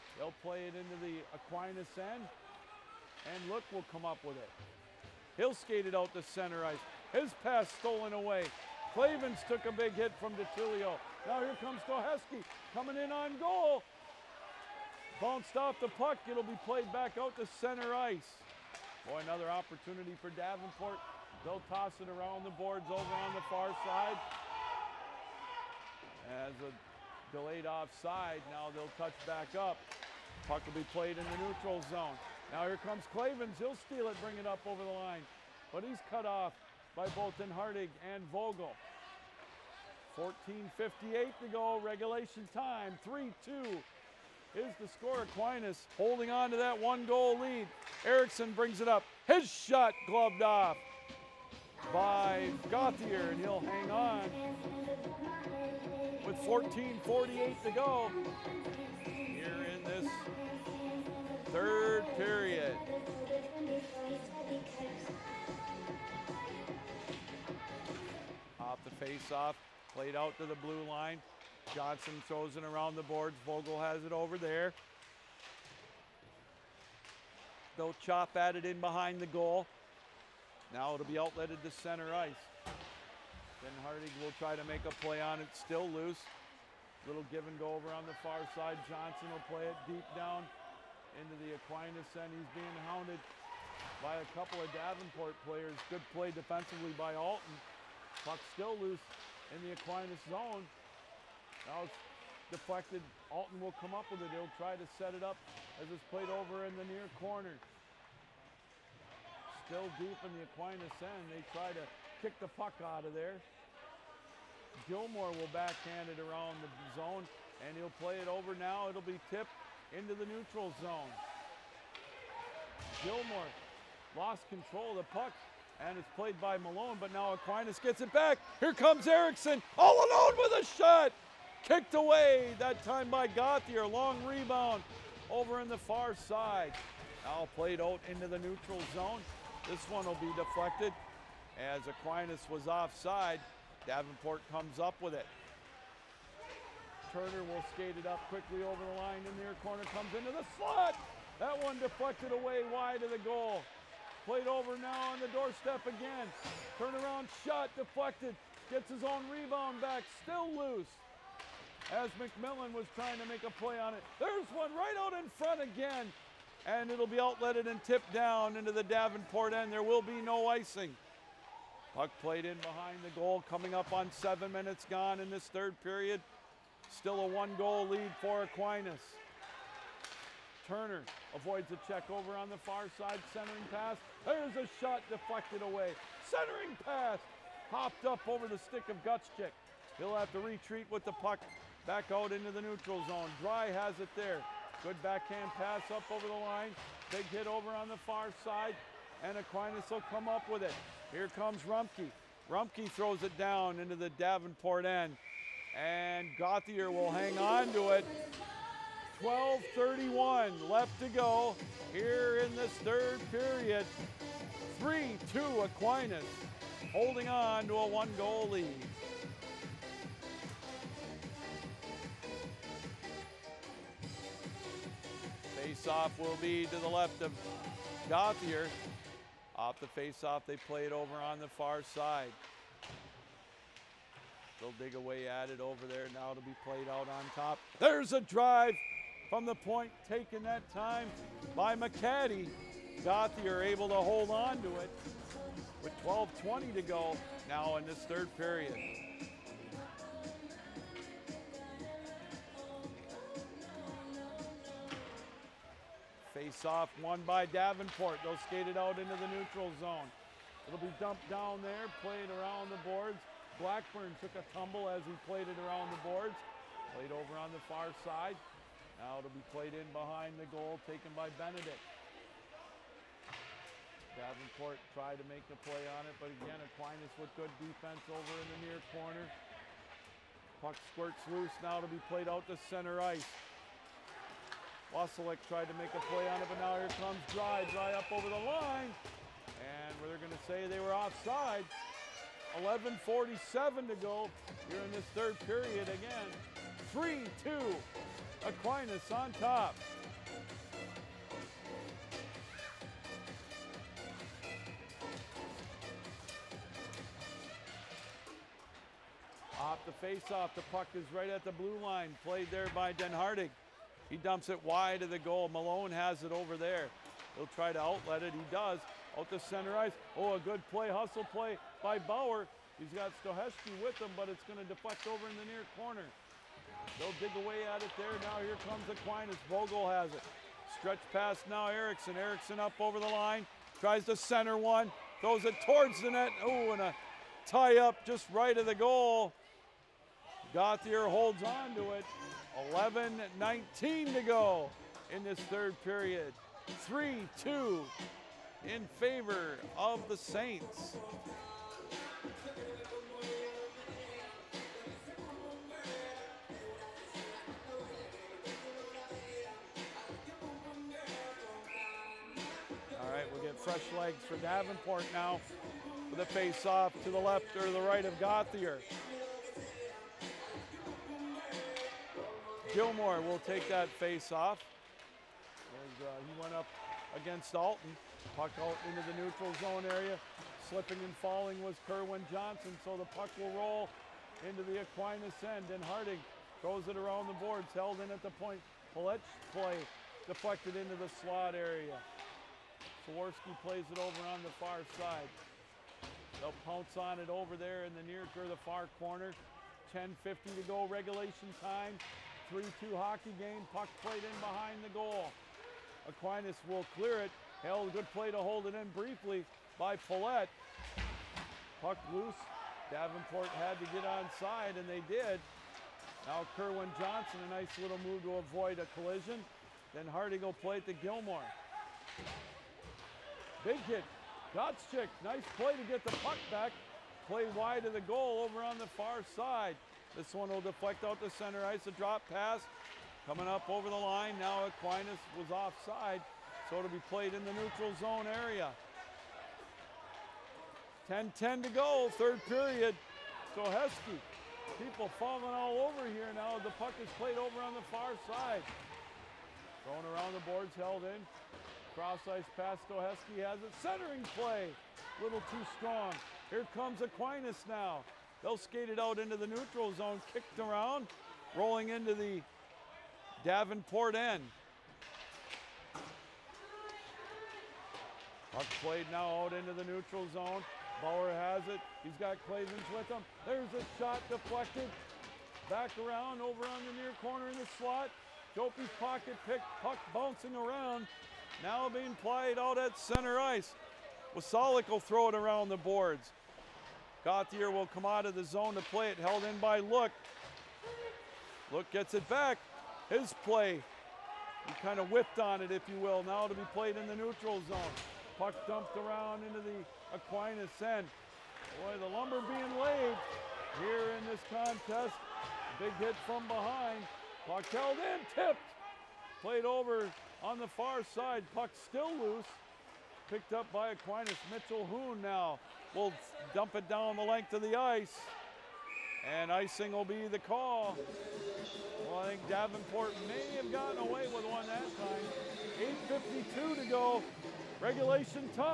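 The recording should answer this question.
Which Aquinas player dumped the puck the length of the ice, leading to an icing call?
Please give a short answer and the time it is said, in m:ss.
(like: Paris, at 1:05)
Mitchell Hoon, at 8:34.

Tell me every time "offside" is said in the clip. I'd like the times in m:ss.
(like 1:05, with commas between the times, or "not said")
0:27, 2:22, 4:50, 7:15.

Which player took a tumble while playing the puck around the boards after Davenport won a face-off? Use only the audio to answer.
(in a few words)
Blackburn.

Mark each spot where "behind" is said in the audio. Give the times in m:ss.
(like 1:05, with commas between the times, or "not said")
1:18, 2:52, 4:29, 6:44, 8:26.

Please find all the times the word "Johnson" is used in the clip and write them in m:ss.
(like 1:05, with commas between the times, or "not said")
1:11, 1:28, 6:22, 6:56.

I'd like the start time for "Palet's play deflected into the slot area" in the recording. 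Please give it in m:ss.
6:28.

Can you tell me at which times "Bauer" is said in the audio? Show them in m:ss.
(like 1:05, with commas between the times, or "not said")
5:21, 7:51.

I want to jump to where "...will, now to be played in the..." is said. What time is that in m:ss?
8:15.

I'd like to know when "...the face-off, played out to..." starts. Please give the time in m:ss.
1:08.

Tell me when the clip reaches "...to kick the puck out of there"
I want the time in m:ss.
1:51.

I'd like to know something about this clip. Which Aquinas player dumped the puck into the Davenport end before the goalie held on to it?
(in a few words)
Rumpke.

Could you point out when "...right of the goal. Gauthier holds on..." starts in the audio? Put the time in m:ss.
5:38.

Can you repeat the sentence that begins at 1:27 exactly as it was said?
Little give and go over on the far side.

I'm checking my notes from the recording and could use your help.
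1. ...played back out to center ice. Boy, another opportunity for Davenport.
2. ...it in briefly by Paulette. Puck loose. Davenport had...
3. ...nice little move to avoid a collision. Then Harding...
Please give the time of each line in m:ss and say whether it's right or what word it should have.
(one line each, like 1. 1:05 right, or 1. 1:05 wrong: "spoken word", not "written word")
1. 0:16 right
2. 6:48 right
3. 6:57 right.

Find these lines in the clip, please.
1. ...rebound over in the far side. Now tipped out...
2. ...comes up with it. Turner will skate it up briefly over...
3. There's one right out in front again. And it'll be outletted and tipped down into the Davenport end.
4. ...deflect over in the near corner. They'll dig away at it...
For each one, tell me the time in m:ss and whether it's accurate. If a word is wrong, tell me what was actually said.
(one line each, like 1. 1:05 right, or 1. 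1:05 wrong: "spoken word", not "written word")
1. 2:14 wrong: "played", not "tipped"
2. 2:24 wrong: "quickly", not "briefly"
3. 2:44 right
4. 5:24 right.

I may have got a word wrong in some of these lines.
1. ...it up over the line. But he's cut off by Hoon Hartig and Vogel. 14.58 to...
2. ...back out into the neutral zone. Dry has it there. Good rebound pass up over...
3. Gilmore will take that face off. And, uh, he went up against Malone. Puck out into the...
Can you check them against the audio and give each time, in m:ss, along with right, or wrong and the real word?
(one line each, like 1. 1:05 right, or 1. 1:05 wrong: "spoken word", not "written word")
1. 0:34 wrong: "Bolton", not "Hoon"
2. 3:11 wrong: "backhand", not "rebound"
3. 6:12 wrong: "Alton", not "Malone".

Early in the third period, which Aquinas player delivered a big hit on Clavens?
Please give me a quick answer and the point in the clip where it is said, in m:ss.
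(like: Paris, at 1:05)
DeTulio, at 0:10.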